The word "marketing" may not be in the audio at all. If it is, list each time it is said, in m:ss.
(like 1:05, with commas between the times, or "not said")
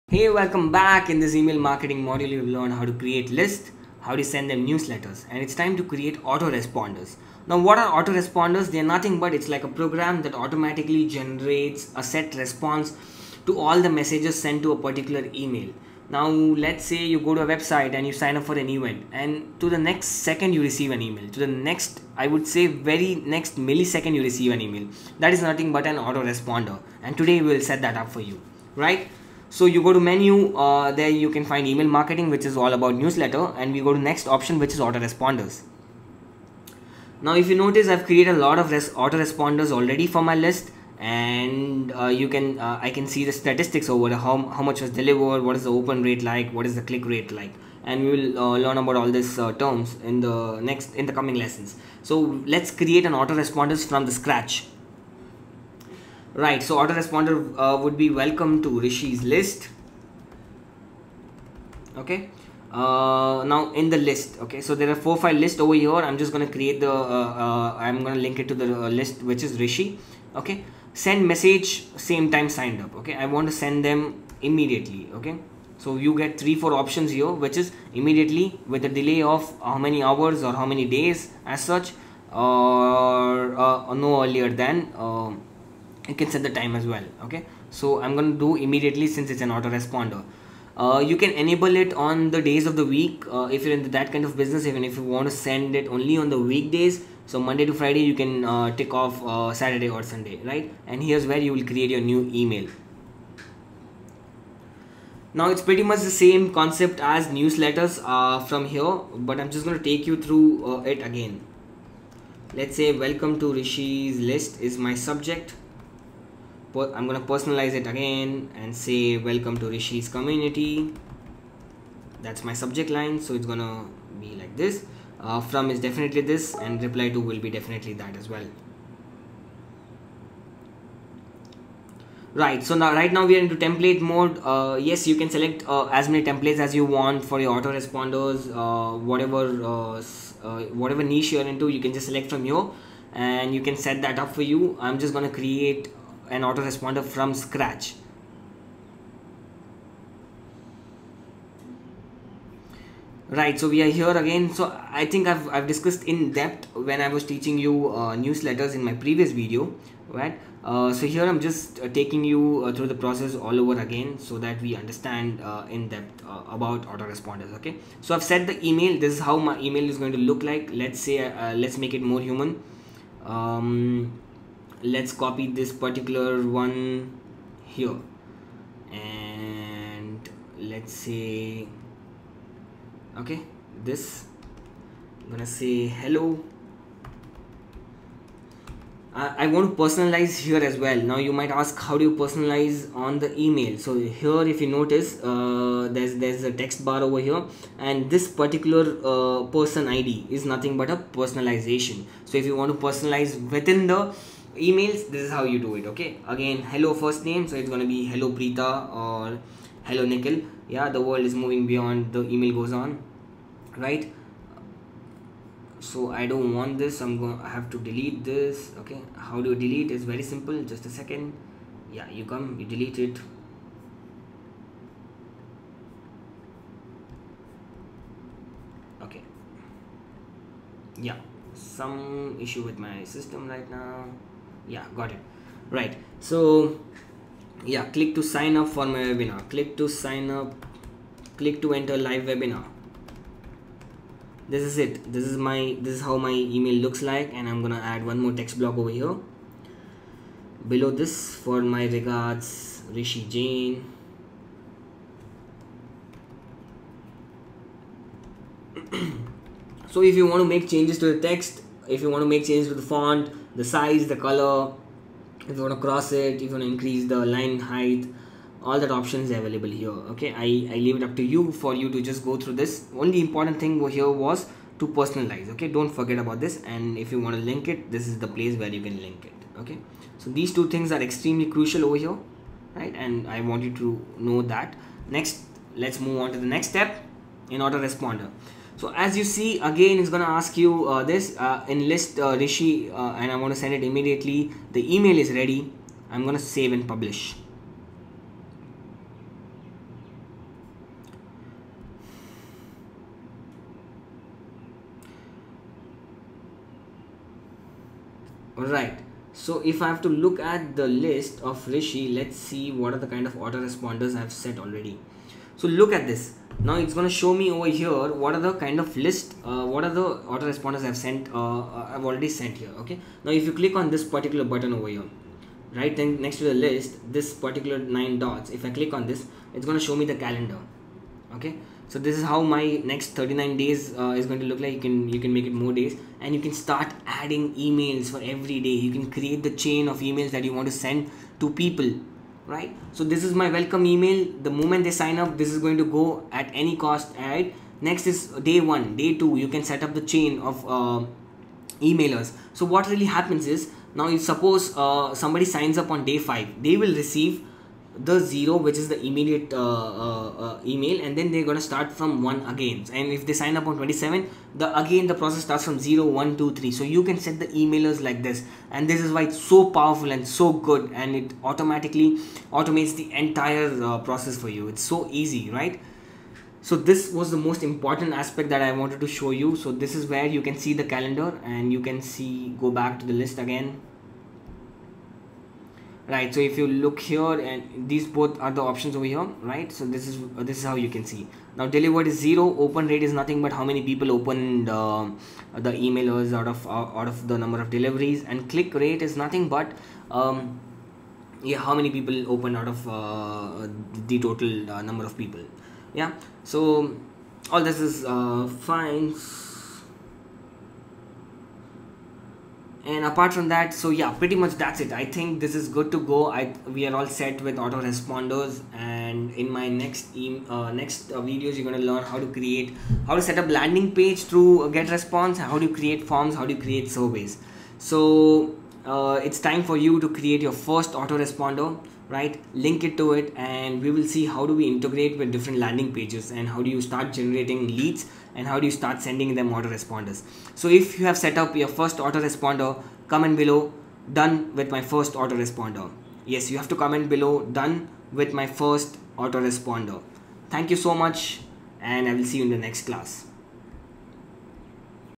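0:01, 0:31.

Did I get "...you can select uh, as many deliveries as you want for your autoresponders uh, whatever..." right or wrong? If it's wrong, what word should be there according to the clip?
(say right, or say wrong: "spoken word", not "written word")
wrong: "templates", not "deliveries".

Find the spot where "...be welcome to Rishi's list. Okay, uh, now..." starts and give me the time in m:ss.
0:57.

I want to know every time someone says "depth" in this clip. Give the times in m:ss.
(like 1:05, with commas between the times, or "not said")
2:36, 2:45.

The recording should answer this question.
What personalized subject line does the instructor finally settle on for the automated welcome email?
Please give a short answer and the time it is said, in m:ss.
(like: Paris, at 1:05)
Welcome to Rishi's community, at 1:59.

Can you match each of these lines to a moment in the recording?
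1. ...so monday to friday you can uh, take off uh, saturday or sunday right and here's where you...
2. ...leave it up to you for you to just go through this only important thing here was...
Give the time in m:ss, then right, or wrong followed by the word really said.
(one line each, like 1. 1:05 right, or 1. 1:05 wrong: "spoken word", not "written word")
1. 1:37 right
2. 4:30 right.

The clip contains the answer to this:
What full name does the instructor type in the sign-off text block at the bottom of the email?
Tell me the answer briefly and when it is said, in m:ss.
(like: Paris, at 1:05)
Rishi Jain, at 4:12.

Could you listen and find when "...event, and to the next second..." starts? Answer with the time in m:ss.
0:18.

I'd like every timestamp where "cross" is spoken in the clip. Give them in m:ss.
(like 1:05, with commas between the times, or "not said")
4:25.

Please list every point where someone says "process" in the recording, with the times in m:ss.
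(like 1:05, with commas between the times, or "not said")
2:43, 6:05, 6:13.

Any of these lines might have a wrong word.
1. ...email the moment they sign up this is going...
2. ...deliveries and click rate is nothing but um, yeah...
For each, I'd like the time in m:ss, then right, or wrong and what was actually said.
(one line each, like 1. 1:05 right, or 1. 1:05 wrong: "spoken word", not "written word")
1. 5:43 right
2. 6:37 right.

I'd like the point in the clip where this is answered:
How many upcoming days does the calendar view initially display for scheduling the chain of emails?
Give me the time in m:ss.
5:32.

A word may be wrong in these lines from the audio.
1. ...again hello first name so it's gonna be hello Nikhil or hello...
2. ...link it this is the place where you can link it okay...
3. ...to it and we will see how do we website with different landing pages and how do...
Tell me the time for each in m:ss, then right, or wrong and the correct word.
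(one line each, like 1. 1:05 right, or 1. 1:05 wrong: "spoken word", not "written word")
1. 3:26 wrong: "Preeta", not "Nikhil"
2. 4:37 right
3. 7:12 wrong: "integrate", not "website".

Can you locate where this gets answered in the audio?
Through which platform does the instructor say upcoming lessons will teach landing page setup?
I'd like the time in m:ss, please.
7:04.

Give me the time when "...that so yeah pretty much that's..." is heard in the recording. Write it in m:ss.
6:53.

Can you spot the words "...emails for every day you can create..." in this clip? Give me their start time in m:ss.
5:37.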